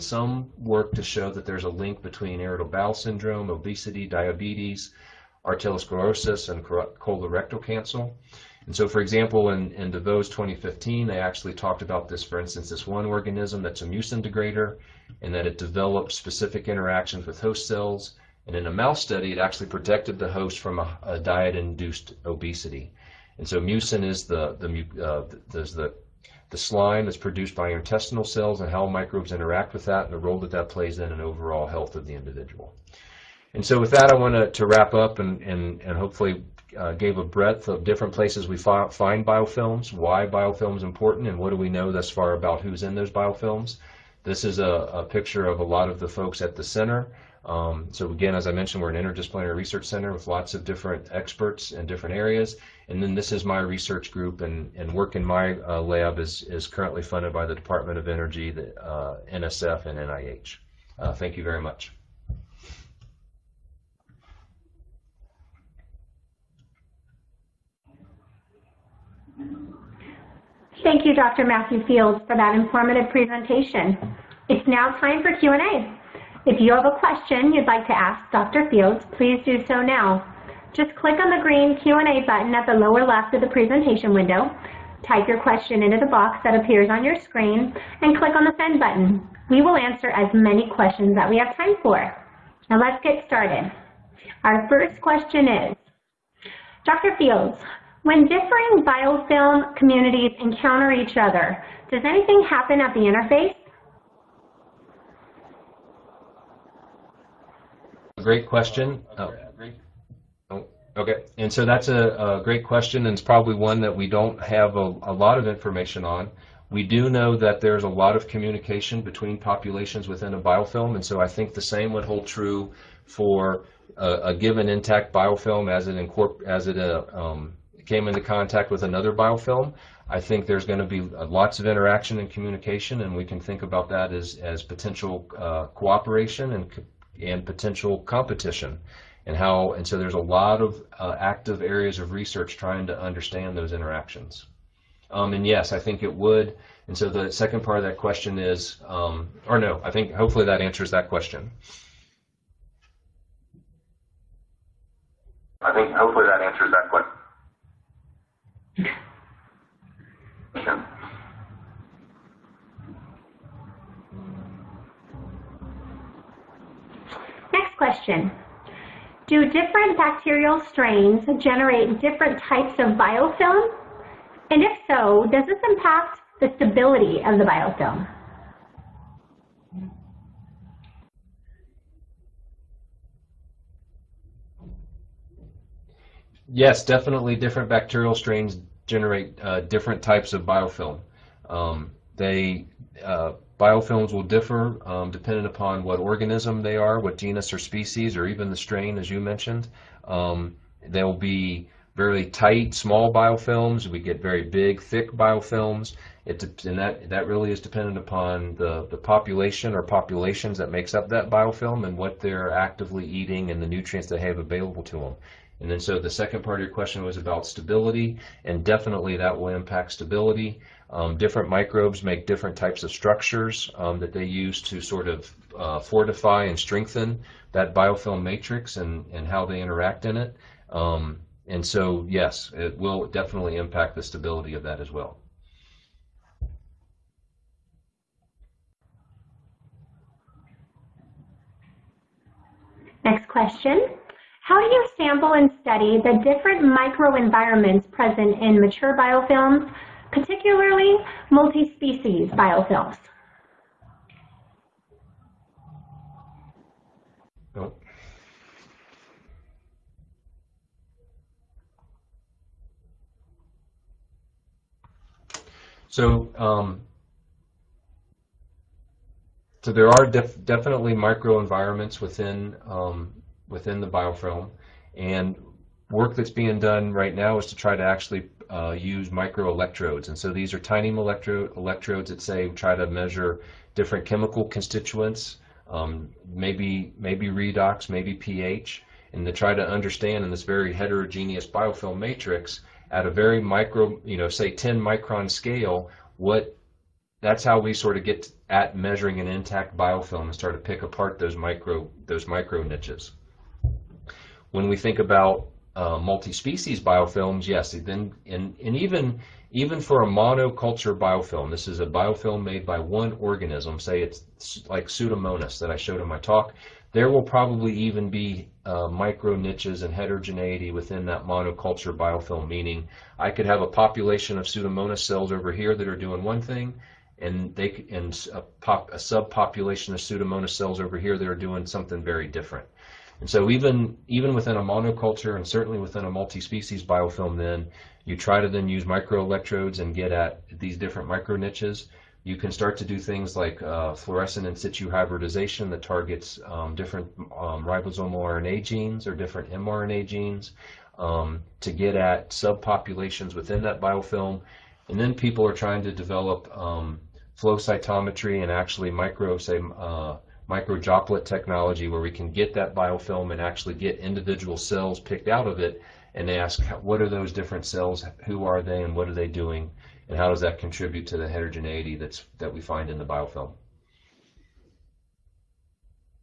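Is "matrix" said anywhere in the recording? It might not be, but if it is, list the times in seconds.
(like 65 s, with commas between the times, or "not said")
228 s, 291 s.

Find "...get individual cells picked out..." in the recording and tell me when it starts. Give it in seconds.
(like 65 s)
363 s.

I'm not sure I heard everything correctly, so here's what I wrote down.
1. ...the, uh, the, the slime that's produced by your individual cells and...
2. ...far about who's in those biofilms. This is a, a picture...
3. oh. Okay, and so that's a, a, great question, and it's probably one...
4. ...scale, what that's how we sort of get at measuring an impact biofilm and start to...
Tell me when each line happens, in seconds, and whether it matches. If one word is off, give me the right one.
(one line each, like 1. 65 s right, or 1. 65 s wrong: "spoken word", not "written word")
1. 24 s wrong: "intestinal", not "individual"
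2. 42 s right
3. 110 s right
4. 295 s wrong: "intact", not "impact".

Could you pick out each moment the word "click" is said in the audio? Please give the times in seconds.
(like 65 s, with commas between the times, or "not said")
80 s, 88 s.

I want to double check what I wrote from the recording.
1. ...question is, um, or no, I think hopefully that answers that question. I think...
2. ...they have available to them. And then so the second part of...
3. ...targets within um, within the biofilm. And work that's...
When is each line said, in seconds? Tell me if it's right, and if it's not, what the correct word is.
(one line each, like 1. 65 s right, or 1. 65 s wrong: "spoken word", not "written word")
1. 147 s right
2. 214 s right
3. 270 s wrong: "microenvironments", not "targets".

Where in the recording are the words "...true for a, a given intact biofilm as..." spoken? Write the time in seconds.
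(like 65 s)
122 s.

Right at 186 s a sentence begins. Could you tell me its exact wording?
Yes, definitely different bacterial strains generate uh, different types of biofilm.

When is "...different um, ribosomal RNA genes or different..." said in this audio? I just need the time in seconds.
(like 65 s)
346 s.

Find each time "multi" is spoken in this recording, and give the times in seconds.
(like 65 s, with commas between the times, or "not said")
251 s, 305 s, 336 s.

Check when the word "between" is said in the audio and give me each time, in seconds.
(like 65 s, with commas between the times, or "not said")
2 s, 119 s.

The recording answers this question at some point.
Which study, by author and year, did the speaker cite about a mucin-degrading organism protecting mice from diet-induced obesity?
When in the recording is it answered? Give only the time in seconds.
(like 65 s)
9 s.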